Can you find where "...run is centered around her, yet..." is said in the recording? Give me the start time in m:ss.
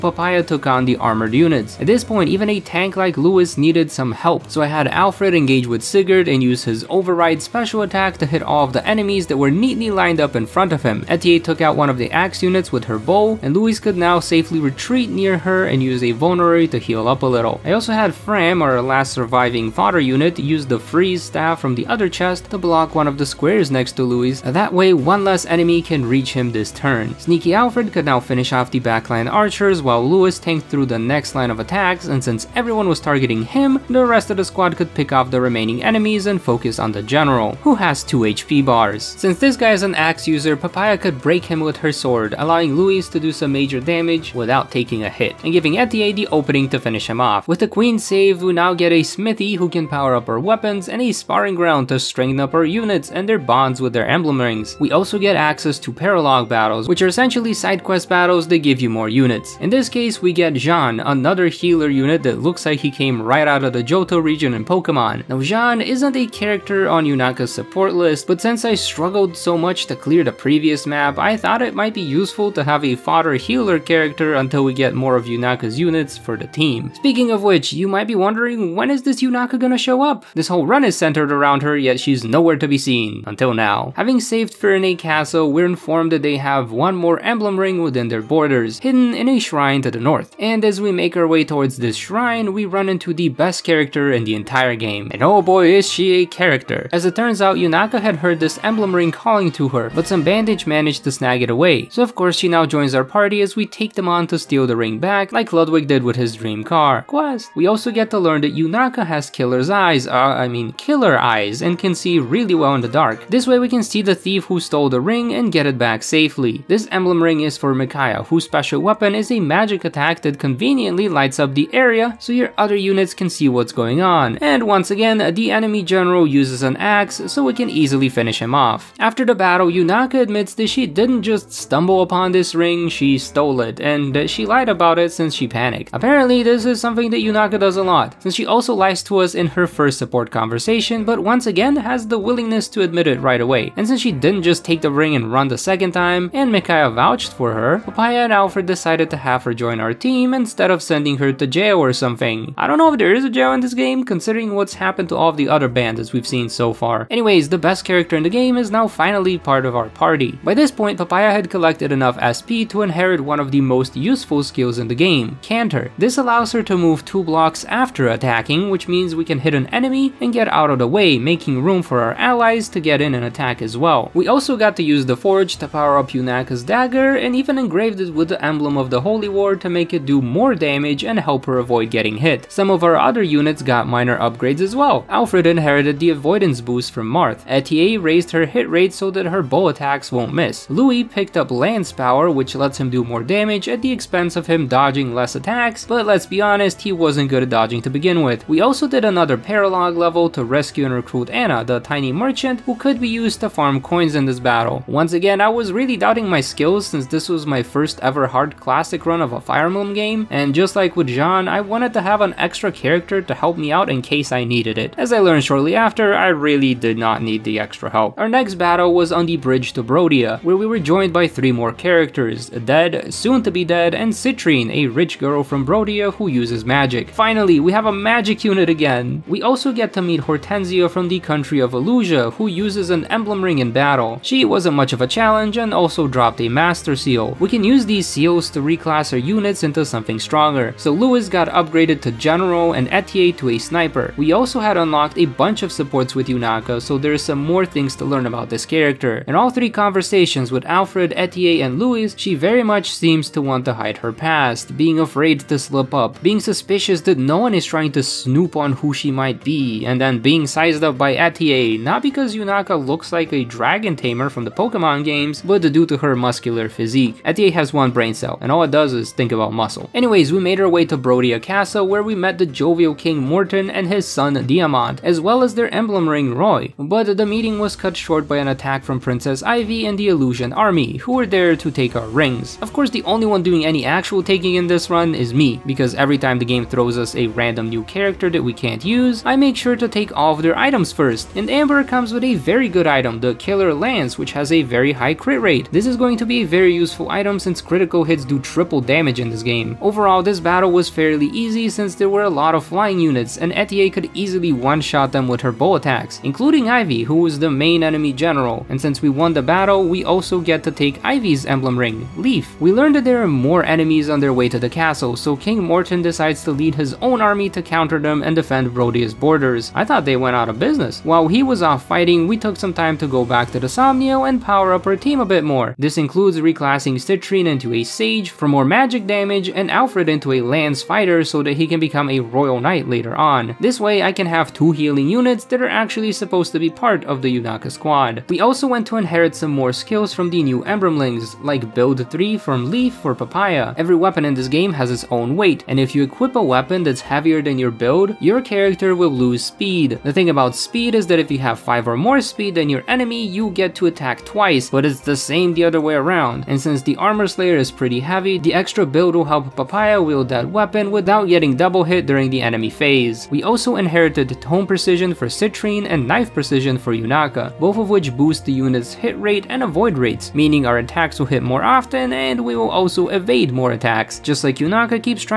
1:20.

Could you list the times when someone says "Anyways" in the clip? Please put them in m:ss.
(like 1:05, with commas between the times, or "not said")
2:37, 4:29.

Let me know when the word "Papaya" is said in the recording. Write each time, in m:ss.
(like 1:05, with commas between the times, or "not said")
0:40, 2:27, 2:40, 5:43, 5:59.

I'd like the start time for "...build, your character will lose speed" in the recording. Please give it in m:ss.
5:47.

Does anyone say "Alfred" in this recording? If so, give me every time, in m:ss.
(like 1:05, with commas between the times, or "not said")
0:04, 0:27, 2:28, 3:05, 4:10, 5:29.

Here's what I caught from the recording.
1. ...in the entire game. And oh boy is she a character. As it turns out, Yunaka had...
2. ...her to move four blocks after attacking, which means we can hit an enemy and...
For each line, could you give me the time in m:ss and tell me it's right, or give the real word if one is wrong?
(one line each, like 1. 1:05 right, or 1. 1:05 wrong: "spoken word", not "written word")
1. 1:34 right
2. 2:46 wrong: "two", not "four".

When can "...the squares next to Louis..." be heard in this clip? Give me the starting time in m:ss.
0:23.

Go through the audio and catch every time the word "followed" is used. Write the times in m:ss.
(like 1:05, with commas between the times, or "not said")
not said.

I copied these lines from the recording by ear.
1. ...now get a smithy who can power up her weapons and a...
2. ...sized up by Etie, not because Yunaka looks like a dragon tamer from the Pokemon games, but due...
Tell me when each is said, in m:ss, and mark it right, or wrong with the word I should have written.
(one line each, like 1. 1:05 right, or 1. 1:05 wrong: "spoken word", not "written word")
1. 0:48 right
2. 4:20 right.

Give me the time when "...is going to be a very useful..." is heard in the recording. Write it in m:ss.
4:55.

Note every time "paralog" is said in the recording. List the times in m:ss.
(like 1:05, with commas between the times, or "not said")
0:55, 3:19.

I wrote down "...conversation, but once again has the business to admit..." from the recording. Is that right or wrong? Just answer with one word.
wrong.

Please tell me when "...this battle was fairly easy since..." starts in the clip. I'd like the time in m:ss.
5:00.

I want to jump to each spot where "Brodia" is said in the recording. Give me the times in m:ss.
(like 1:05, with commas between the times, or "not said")
3:39, 3:45, 4:30, 5:18.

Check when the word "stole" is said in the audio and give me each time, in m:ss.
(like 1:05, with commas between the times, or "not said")
1:54, 2:13.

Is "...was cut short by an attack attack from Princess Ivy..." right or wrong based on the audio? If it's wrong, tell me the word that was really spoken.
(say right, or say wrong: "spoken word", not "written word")
right.